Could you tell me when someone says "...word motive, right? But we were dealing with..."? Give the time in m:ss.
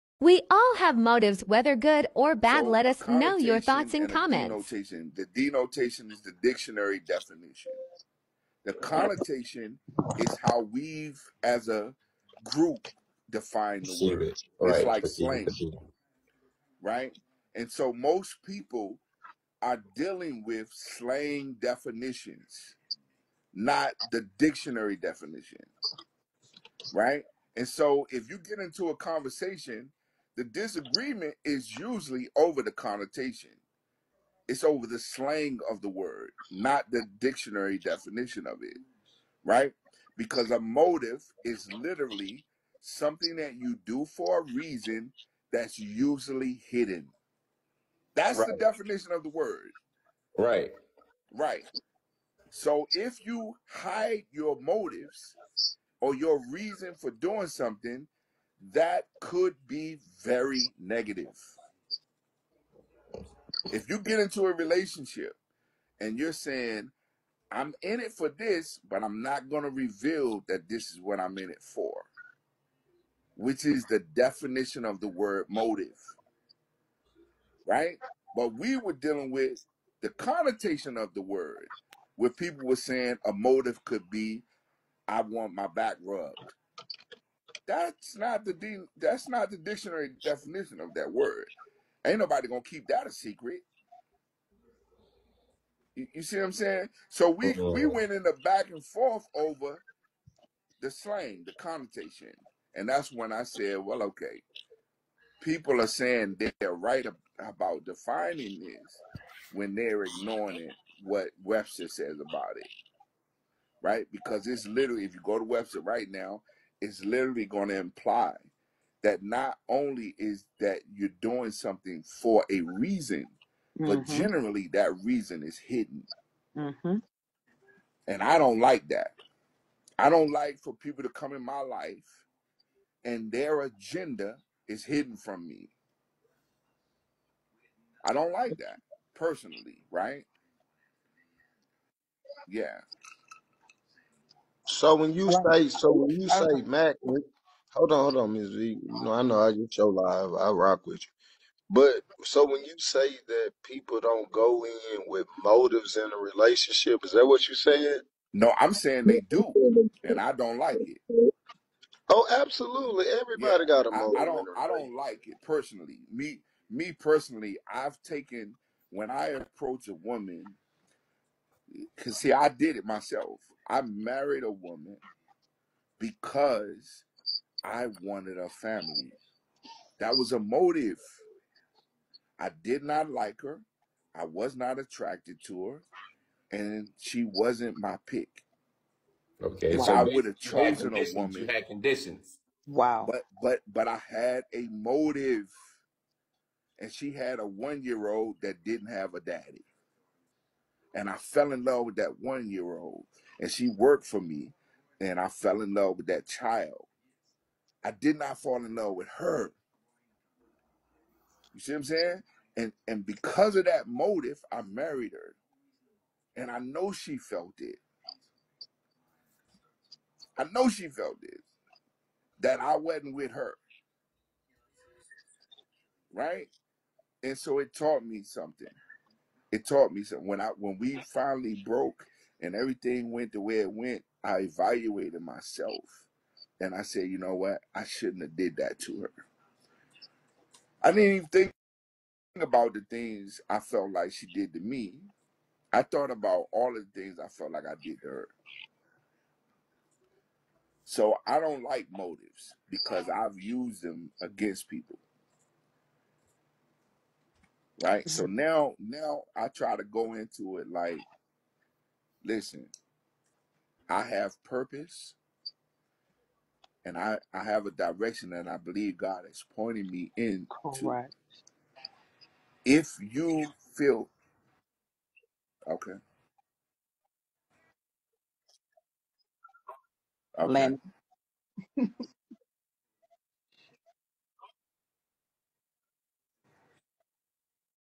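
1:15.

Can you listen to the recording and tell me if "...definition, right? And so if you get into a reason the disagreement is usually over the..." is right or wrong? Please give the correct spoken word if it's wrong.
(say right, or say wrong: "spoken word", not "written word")
wrong: "conversation", not "reason".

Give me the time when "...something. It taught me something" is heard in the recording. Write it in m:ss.
3:48.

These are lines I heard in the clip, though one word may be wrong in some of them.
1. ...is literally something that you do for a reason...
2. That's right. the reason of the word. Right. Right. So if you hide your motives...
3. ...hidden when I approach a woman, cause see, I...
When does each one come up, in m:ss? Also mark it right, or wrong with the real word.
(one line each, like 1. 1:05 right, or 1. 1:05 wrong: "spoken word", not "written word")
1. 0:41 right
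2. 0:48 wrong: "definition", not "reason"
3. 2:48 wrong: "taken", not "hidden".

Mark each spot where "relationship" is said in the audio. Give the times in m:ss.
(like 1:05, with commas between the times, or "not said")
1:04, 2:36.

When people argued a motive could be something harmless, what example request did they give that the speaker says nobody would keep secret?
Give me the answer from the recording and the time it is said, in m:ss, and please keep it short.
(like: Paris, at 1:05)
I want my back rubbed, at 1:25.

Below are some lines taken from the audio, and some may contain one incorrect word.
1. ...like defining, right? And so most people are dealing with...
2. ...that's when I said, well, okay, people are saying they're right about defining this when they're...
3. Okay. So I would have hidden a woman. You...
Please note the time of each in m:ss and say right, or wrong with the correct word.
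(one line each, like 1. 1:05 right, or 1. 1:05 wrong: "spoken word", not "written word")
1. 0:14 wrong: "slang", not "defining"
2. 1:42 right
3. 3:09 wrong: "chosen", not "hidden".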